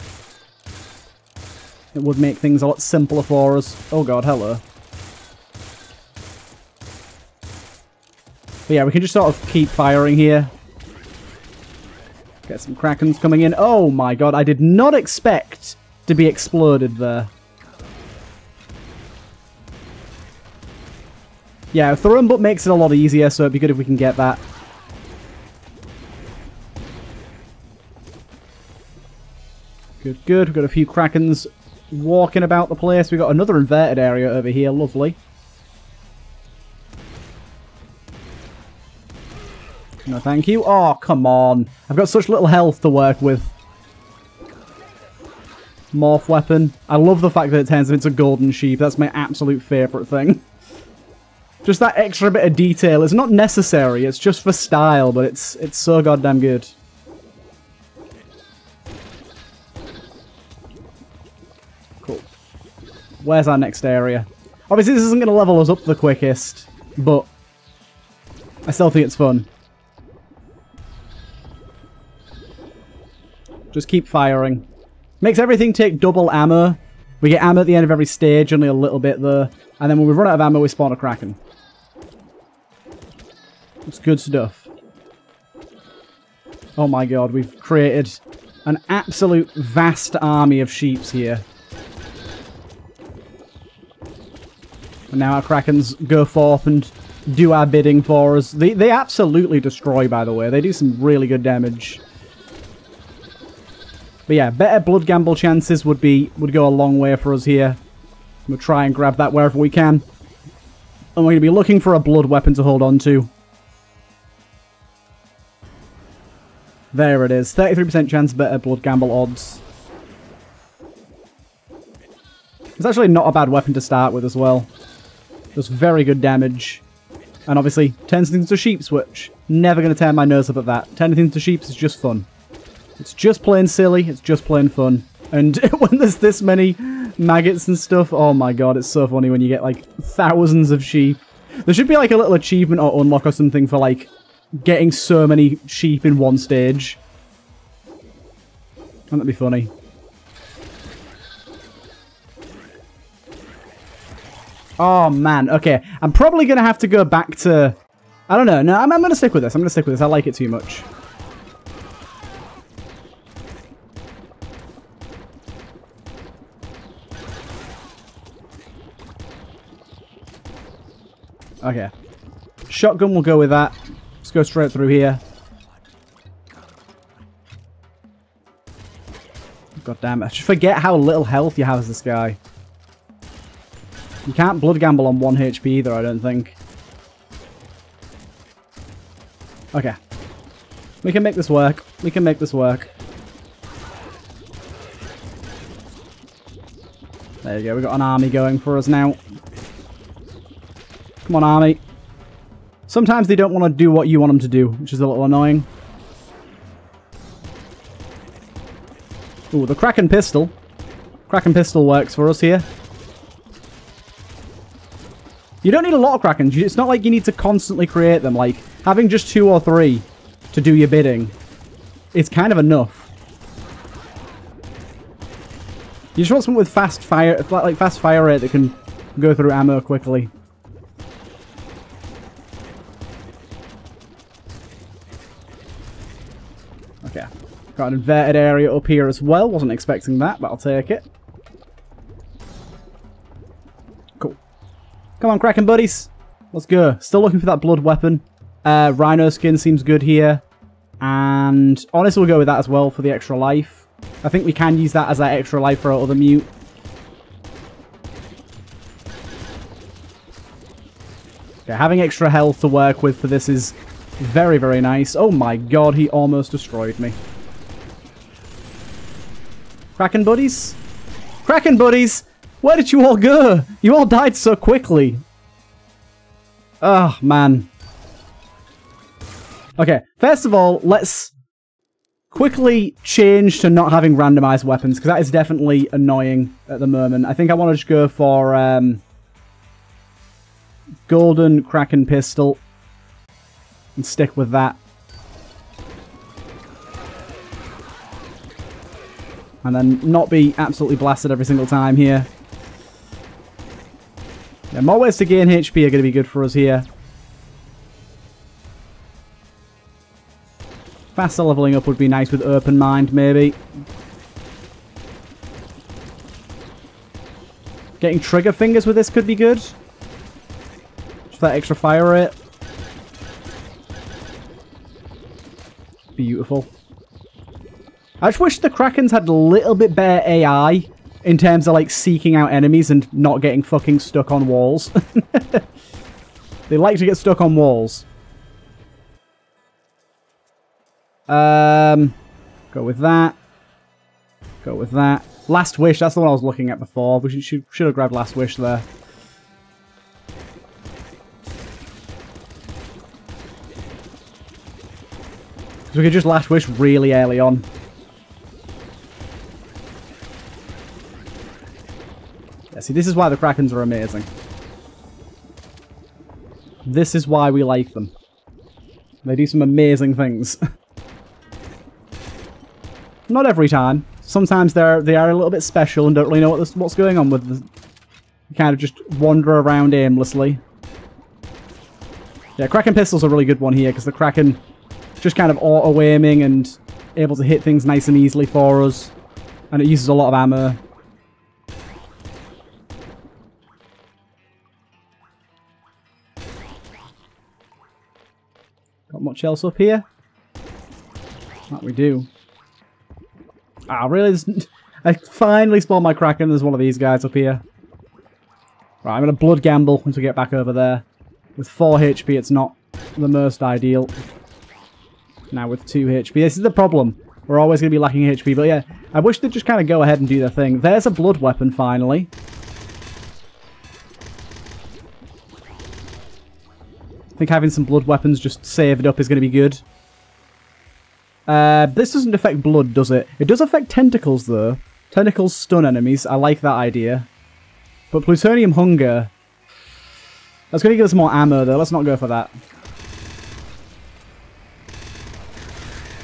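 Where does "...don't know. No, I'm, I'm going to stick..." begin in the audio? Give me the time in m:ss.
2:38.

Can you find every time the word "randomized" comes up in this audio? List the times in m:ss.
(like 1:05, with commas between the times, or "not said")
4:44.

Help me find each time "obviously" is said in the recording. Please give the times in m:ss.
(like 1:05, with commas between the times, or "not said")
1:04, 2:07.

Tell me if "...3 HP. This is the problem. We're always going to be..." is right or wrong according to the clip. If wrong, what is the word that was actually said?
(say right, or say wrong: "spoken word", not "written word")
wrong: "2", not "3".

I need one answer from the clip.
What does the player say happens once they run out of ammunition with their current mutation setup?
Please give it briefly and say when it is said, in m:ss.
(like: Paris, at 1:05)
spawn a Kraken, at 1:20.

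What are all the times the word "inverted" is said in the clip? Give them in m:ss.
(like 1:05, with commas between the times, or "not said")
0:33, 3:57.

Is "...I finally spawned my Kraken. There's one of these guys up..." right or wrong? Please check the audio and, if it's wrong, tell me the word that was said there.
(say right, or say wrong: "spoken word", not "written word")
right.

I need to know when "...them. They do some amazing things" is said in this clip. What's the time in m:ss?
6:07.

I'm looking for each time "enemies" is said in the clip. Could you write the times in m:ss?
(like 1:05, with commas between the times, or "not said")
5:32, 7:15.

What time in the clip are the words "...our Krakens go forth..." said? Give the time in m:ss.
1:35.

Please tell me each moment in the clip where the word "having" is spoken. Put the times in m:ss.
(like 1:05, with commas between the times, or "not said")
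3:38, 4:21, 4:43, 7:07.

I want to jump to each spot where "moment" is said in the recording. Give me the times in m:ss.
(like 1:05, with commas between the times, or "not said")
4:46.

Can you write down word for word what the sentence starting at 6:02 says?
See, this is why the Krakens are amazing.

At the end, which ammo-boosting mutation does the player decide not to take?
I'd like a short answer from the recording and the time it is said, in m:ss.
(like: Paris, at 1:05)
plutonium hunger, at 7:18.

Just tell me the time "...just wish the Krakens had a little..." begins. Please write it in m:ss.
5:28.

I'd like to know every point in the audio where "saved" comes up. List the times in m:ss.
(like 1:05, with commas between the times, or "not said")
7:08.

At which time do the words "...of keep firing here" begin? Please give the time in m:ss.
0:09.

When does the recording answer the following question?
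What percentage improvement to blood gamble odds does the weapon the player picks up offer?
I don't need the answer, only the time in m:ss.
1:57.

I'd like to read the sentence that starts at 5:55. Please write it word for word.
So we could just Last Wish really early on.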